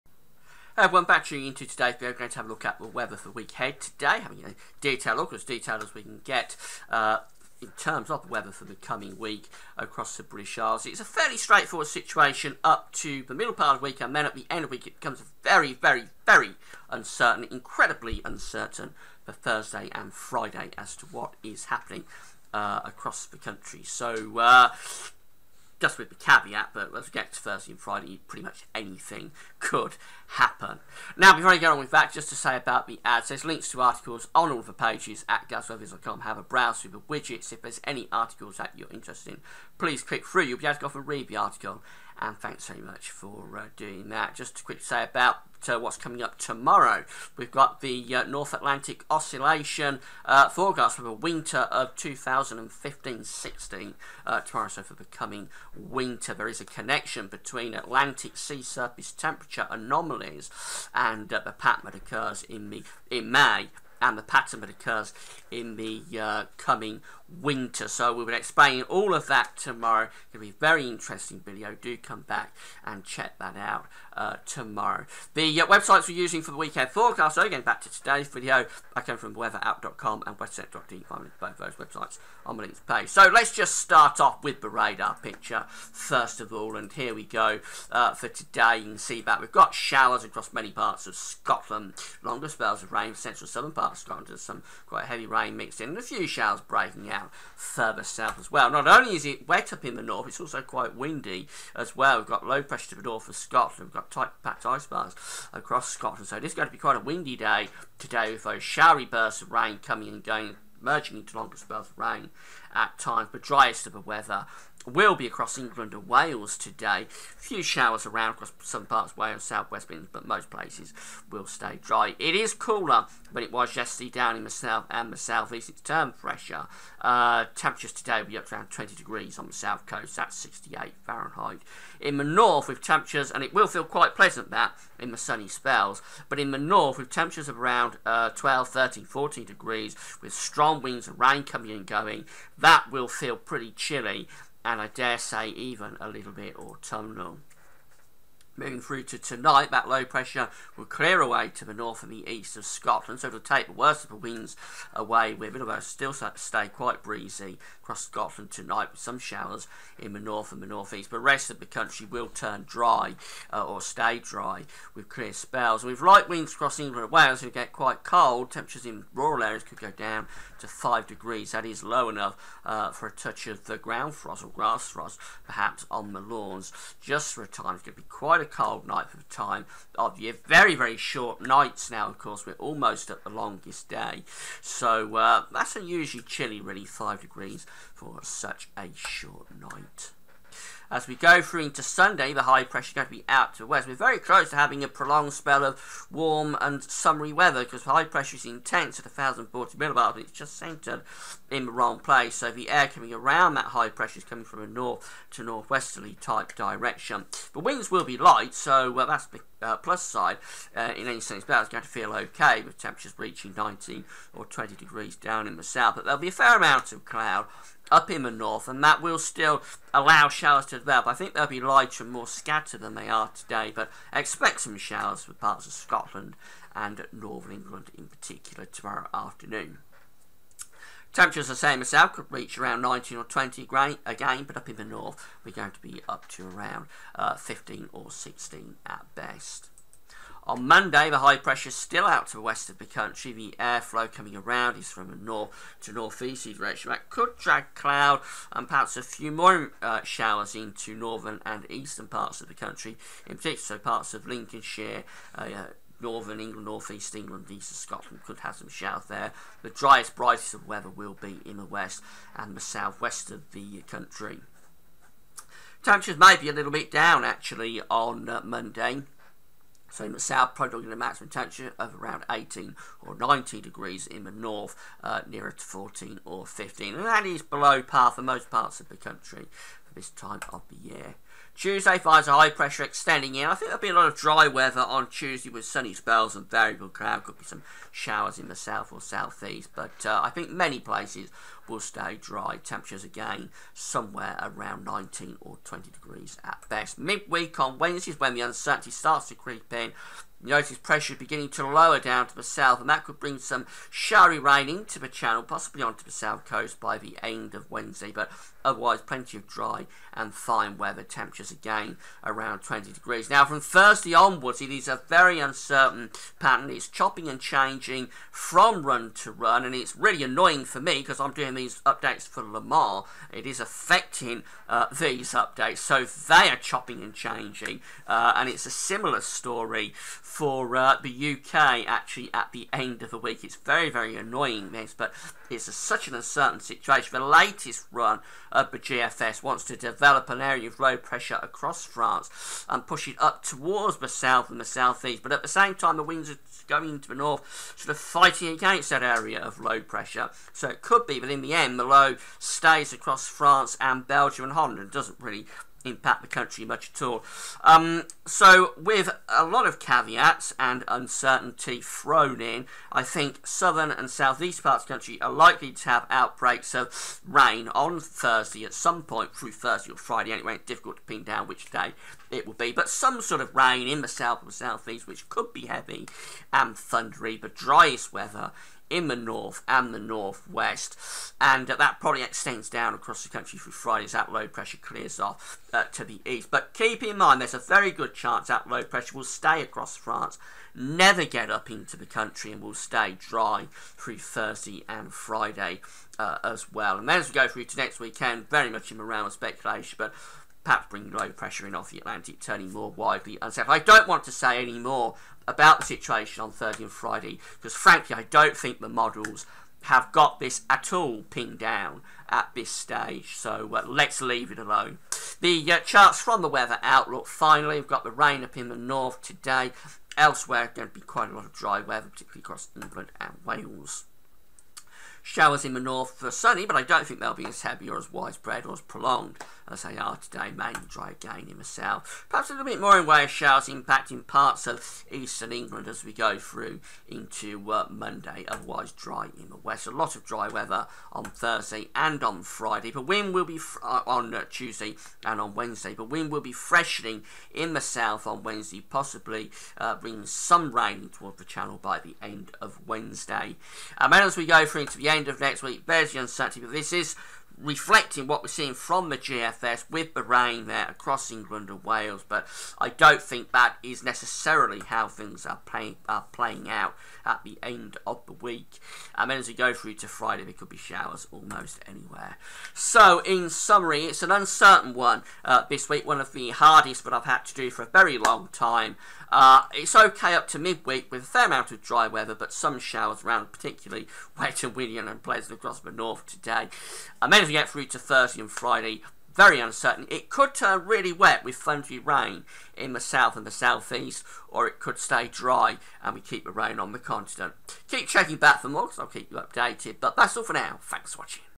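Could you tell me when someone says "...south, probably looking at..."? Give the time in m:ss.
4:30.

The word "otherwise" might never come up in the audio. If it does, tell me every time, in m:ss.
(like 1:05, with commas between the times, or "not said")
5:08, 7:18.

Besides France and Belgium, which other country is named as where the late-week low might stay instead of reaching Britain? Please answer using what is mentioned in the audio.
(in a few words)
Holland.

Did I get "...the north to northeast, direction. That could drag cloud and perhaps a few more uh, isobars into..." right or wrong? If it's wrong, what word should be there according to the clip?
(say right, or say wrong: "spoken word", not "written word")
wrong: "showers", not "isobars".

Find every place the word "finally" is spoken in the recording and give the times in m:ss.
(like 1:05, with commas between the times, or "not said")
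6:57.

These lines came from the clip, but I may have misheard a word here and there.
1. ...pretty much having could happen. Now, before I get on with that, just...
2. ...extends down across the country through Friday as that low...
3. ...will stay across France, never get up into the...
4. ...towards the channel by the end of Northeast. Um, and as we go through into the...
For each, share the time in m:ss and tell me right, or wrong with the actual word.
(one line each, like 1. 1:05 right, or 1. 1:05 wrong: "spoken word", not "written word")
1. 0:28 wrong: "anything", not "having"
2. 6:22 right
3. 6:29 right
4. 7:31 wrong: "Wednesday", not "Northeast".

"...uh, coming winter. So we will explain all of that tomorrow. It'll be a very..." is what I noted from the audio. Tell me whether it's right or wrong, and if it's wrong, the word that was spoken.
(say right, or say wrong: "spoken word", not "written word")
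right.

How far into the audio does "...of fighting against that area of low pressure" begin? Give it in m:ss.
5:47.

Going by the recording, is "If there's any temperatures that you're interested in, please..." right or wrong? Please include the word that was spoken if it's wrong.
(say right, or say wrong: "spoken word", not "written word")
wrong: "articles", not "temperatures".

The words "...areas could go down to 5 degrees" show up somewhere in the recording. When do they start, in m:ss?
2:49.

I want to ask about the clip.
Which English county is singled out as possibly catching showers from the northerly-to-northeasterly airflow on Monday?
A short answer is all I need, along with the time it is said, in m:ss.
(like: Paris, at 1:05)
Lincolnshire, at 4:14.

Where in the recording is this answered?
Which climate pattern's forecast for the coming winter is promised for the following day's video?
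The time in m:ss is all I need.
0:48.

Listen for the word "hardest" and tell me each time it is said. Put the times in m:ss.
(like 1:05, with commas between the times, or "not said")
7:56.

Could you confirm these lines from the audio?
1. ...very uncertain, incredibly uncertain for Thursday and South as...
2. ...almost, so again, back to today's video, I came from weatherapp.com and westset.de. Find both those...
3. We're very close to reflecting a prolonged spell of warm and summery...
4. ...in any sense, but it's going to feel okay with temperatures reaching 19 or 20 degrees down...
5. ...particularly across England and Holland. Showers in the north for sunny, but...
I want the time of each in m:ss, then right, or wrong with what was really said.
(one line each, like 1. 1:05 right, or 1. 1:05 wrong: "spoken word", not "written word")
1. 0:16 wrong: "Friday", not "South"
2. 1:16 wrong: "forecast", not "almost"
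3. 3:13 wrong: "having", not "reflecting"
4. 3:30 right
5. 7:02 wrong: "Wales", not "Holland".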